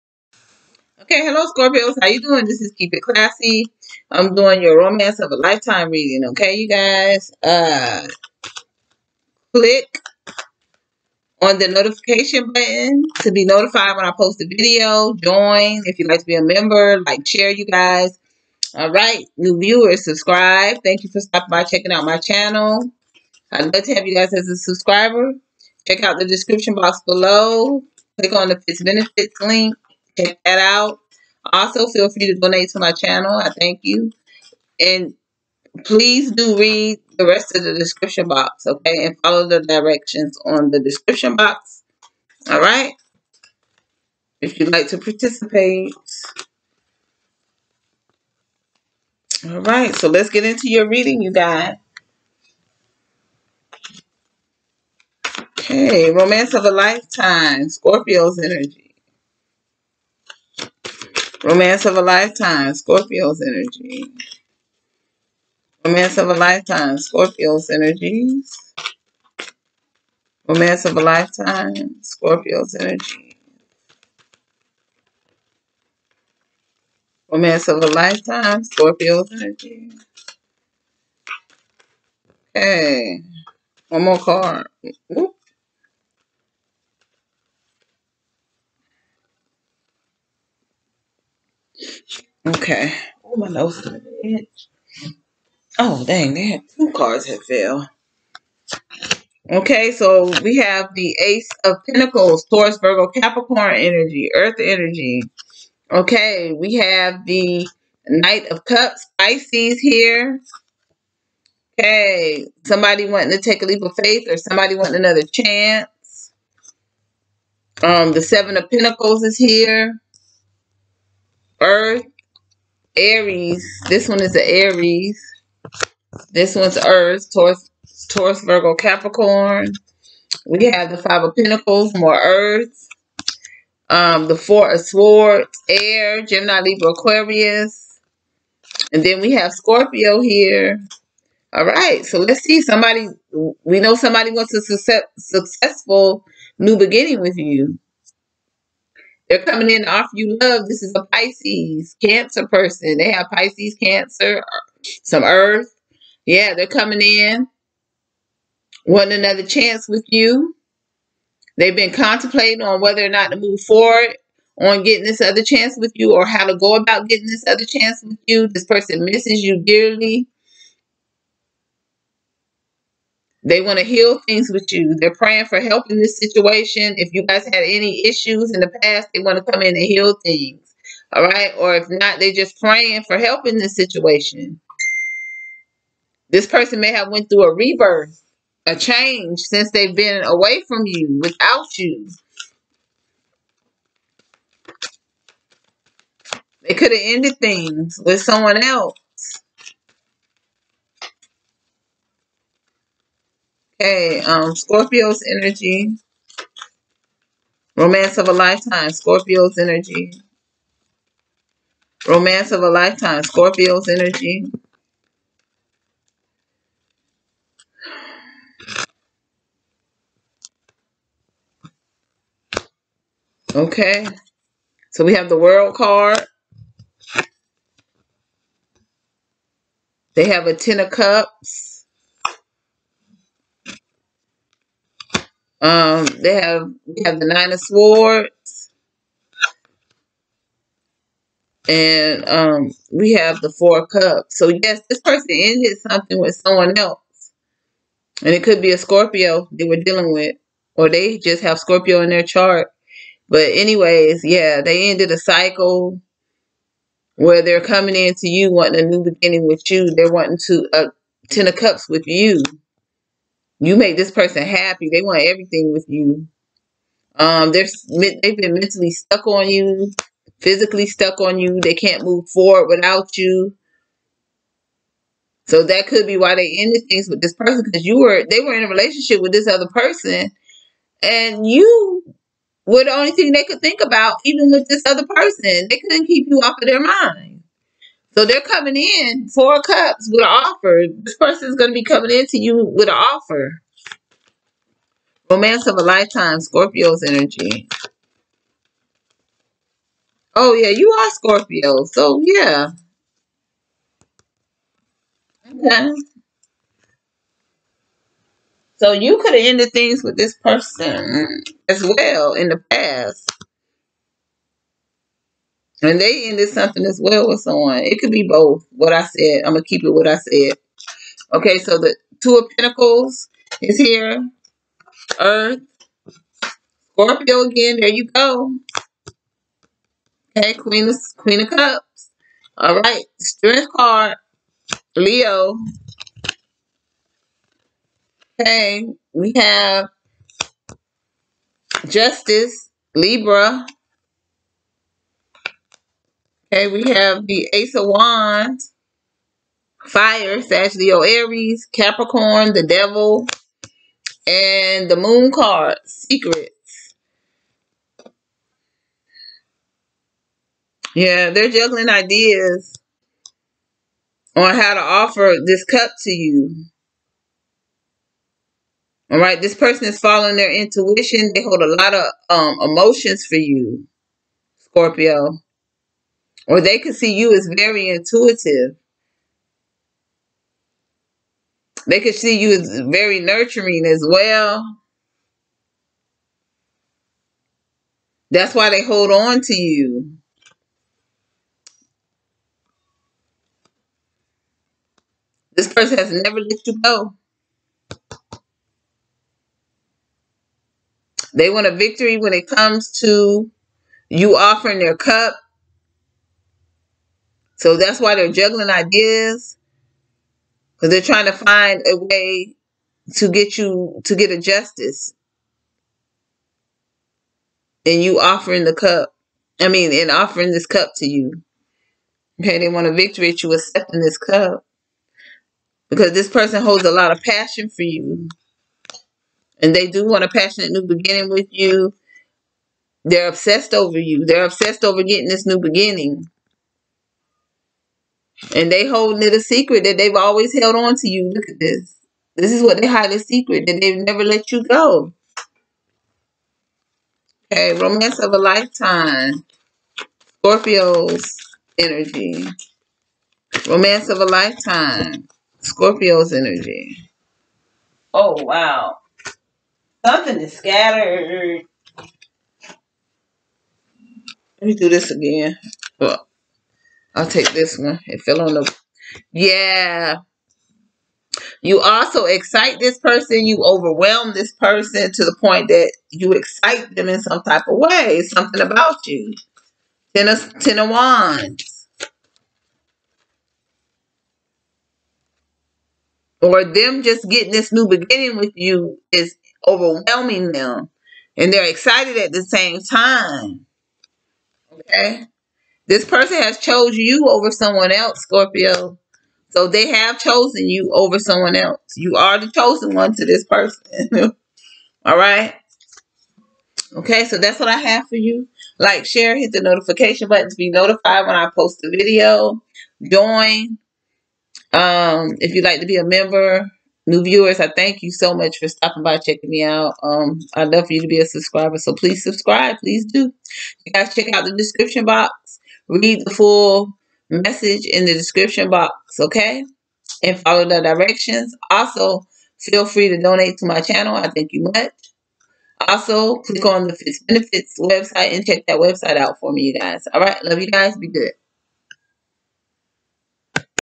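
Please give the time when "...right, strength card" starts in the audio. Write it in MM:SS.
05:32.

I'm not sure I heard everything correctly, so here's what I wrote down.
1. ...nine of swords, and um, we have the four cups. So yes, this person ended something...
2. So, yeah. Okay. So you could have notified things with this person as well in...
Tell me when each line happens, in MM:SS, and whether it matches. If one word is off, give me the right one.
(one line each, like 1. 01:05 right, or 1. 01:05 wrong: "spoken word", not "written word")
1. 03:57 right
2. 05:01 wrong: "ended", not "notified".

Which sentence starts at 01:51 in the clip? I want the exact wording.
Okay, somebody wanting to take a leap of faith or somebody wanting another chance.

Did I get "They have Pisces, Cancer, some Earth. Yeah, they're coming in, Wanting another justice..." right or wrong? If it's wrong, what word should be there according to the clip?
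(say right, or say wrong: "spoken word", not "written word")
wrong: "chance", not "justice".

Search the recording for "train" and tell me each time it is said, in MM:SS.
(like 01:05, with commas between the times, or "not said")
not said.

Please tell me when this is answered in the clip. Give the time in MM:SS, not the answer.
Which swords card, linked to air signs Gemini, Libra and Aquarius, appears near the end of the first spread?
02:14.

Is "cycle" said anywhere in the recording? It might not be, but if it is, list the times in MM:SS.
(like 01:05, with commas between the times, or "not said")
04:15.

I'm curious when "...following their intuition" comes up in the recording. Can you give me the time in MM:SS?
06:10.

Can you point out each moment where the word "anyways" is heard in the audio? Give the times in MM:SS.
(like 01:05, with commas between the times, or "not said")
04:13.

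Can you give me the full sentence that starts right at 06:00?
Yeah, they're juggling ideas on how to offer this cup to you.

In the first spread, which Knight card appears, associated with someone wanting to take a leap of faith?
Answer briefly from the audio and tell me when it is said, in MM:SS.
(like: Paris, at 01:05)
Knight of Cups, at 01:48.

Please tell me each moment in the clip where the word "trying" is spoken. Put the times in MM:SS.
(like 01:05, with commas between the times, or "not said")
06:51.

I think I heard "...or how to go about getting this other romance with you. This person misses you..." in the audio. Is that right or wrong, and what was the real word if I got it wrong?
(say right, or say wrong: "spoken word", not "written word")
wrong: "chance", not "romance".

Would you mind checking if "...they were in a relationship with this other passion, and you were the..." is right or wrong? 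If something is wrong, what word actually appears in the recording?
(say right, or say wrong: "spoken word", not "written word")
wrong: "person", not "passion".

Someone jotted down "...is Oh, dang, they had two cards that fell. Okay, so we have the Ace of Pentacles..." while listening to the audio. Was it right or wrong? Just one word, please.
right.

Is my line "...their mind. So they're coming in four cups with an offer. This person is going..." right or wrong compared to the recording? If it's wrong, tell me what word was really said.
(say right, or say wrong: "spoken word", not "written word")
right.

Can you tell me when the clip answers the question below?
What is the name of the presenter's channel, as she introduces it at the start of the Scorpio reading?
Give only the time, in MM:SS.
00:02.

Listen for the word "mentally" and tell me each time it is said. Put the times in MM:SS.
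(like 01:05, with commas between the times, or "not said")
04:28.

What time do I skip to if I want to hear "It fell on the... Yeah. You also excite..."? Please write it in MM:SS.
07:48.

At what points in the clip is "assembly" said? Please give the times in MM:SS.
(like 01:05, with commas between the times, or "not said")
not said.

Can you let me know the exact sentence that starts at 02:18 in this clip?
And then we have Scorpio here.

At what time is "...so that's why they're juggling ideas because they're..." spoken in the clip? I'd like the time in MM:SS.
06:47.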